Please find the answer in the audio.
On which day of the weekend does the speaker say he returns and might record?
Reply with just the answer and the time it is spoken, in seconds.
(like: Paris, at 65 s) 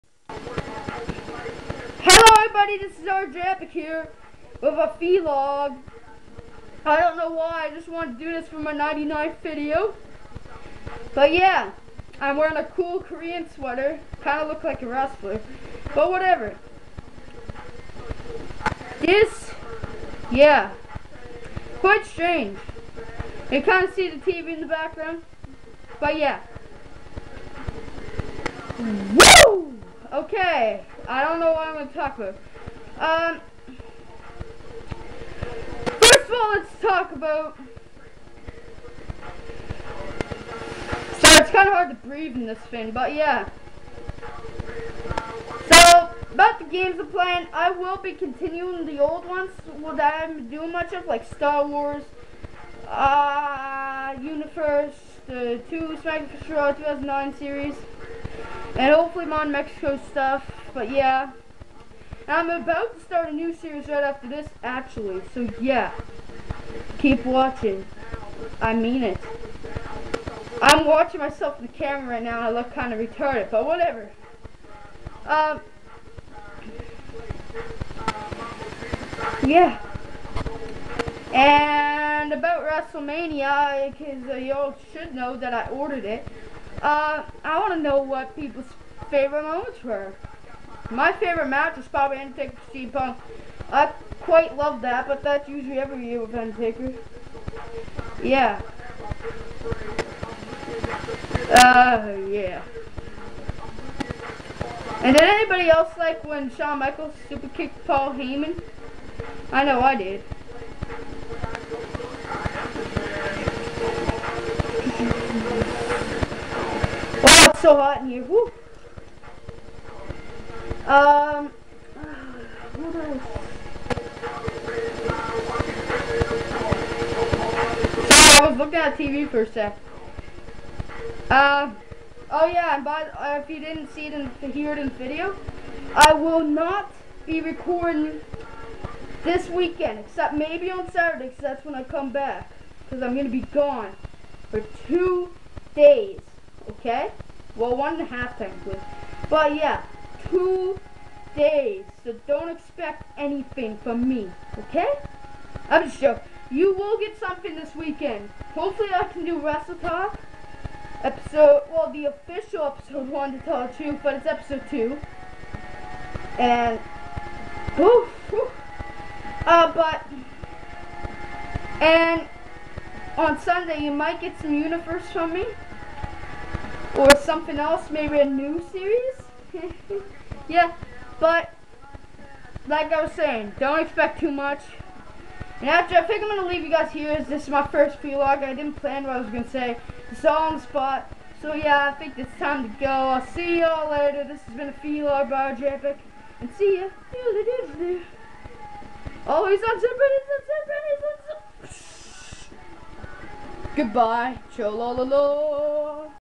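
Saturday, at 140 s.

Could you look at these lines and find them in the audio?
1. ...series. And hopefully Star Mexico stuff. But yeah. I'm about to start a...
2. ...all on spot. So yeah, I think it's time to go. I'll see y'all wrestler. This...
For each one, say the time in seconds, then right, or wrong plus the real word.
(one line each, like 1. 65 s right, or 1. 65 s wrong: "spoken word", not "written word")
1. 57 s wrong: "Mon", not "Star"
2. 190 s wrong: "later", not "wrestler".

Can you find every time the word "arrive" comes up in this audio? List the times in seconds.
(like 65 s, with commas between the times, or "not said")
not said.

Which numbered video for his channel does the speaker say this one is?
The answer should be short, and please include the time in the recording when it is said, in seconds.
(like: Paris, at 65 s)
99th, at 8 s.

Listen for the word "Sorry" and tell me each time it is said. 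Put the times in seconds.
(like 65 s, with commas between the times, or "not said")
41 s, 128 s.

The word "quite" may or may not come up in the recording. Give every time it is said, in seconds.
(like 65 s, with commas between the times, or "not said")
21 s, 94 s.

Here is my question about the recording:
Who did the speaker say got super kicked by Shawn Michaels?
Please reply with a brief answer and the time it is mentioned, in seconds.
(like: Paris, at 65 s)
Paul Heyman, at 107 s.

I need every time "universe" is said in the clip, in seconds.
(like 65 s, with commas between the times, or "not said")
54 s, 174 s.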